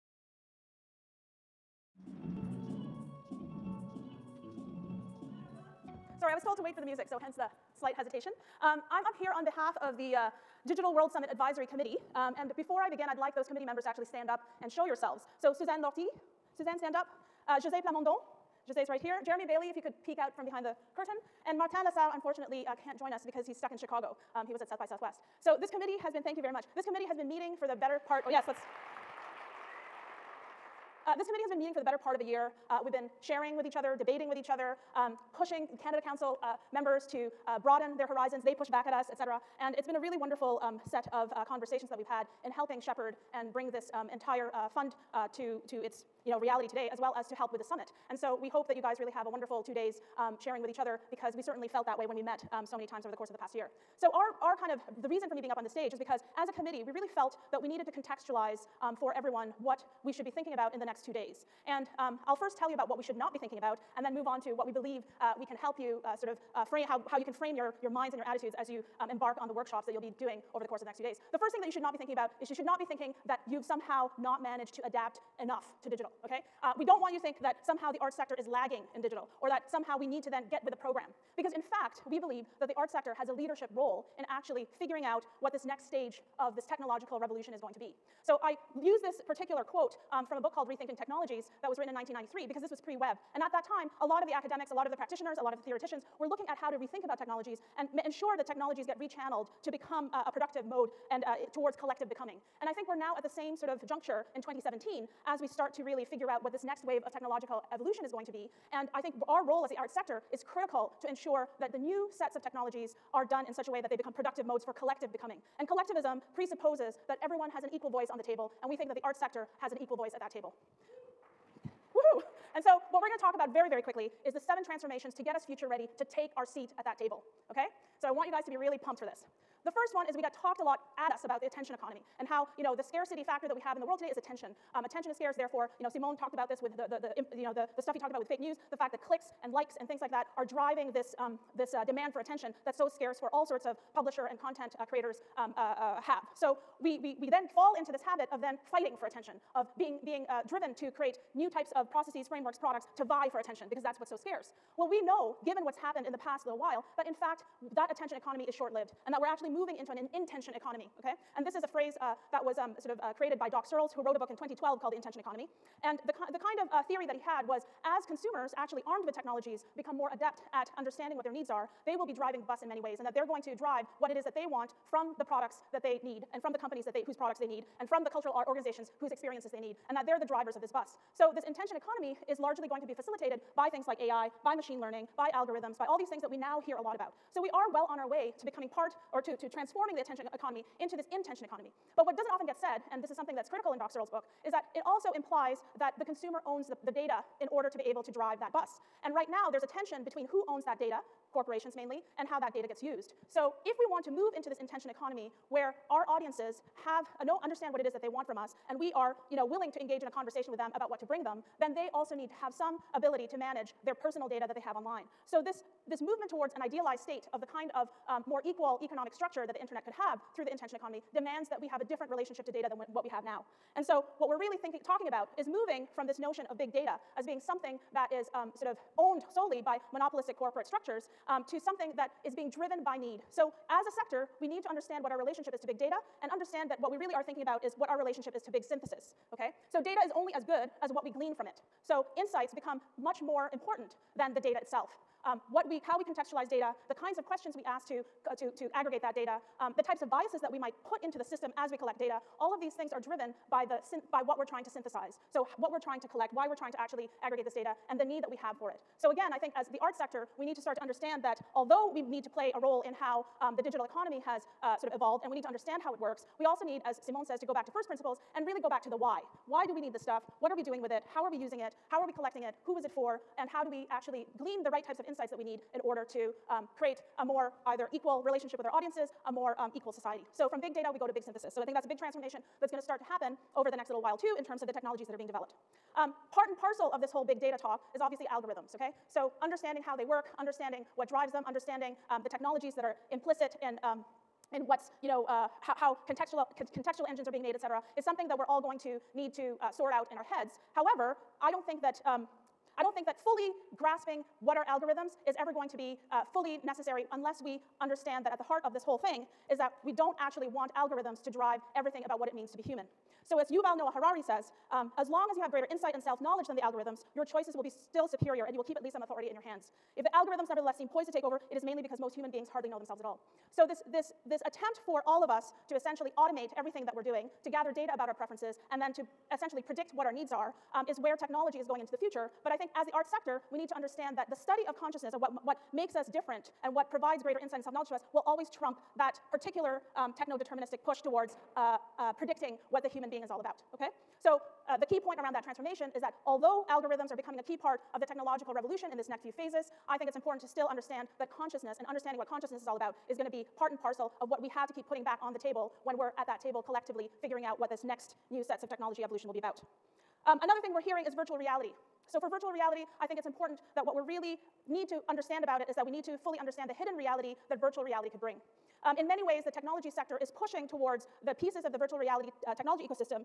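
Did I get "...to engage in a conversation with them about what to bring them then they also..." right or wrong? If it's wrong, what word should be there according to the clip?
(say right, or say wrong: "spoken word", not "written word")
right.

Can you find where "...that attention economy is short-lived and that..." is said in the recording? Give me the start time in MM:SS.
02:37.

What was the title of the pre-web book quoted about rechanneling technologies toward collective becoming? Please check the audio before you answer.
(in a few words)
Rethinking Technologies.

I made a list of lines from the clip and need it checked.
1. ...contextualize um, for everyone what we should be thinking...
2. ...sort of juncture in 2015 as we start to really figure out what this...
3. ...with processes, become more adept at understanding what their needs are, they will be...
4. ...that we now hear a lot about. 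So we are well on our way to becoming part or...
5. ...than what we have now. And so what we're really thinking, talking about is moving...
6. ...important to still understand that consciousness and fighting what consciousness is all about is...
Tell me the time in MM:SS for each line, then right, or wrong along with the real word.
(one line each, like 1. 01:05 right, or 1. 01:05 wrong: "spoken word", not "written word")
1. 00:57 right
2. 01:43 wrong: "2017", not "2015"
3. 02:49 wrong: "technologies", not "processes"
4. 03:06 right
5. 03:42 right
6. 05:50 wrong: "understanding", not "fighting".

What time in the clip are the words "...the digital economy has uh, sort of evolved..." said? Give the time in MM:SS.
04:23.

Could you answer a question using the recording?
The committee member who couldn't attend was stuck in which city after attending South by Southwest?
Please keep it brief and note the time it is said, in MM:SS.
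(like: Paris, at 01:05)
Chicago, at 00:23.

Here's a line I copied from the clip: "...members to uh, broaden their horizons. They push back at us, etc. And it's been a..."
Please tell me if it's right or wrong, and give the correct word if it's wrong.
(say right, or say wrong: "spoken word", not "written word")
right.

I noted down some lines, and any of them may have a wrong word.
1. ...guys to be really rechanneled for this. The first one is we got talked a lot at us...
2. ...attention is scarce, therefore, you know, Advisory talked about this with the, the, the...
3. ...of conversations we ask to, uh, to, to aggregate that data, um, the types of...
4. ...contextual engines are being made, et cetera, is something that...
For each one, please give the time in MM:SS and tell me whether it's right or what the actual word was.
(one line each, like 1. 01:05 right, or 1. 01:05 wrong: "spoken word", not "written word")
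1. 02:08 wrong: "pumped", not "rechanneled"
2. 02:14 wrong: "Simon", not "Advisory"
3. 04:07 wrong: "questions", not "conversations"
4. 04:56 right.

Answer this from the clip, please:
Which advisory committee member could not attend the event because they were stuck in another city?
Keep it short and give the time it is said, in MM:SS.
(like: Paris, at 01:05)
Martin LaSalle, at 00:21.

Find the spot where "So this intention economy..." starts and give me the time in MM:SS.
03:01.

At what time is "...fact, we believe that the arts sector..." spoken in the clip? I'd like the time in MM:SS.
01:21.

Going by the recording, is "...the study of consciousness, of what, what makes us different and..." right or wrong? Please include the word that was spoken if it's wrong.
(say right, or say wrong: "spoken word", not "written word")
right.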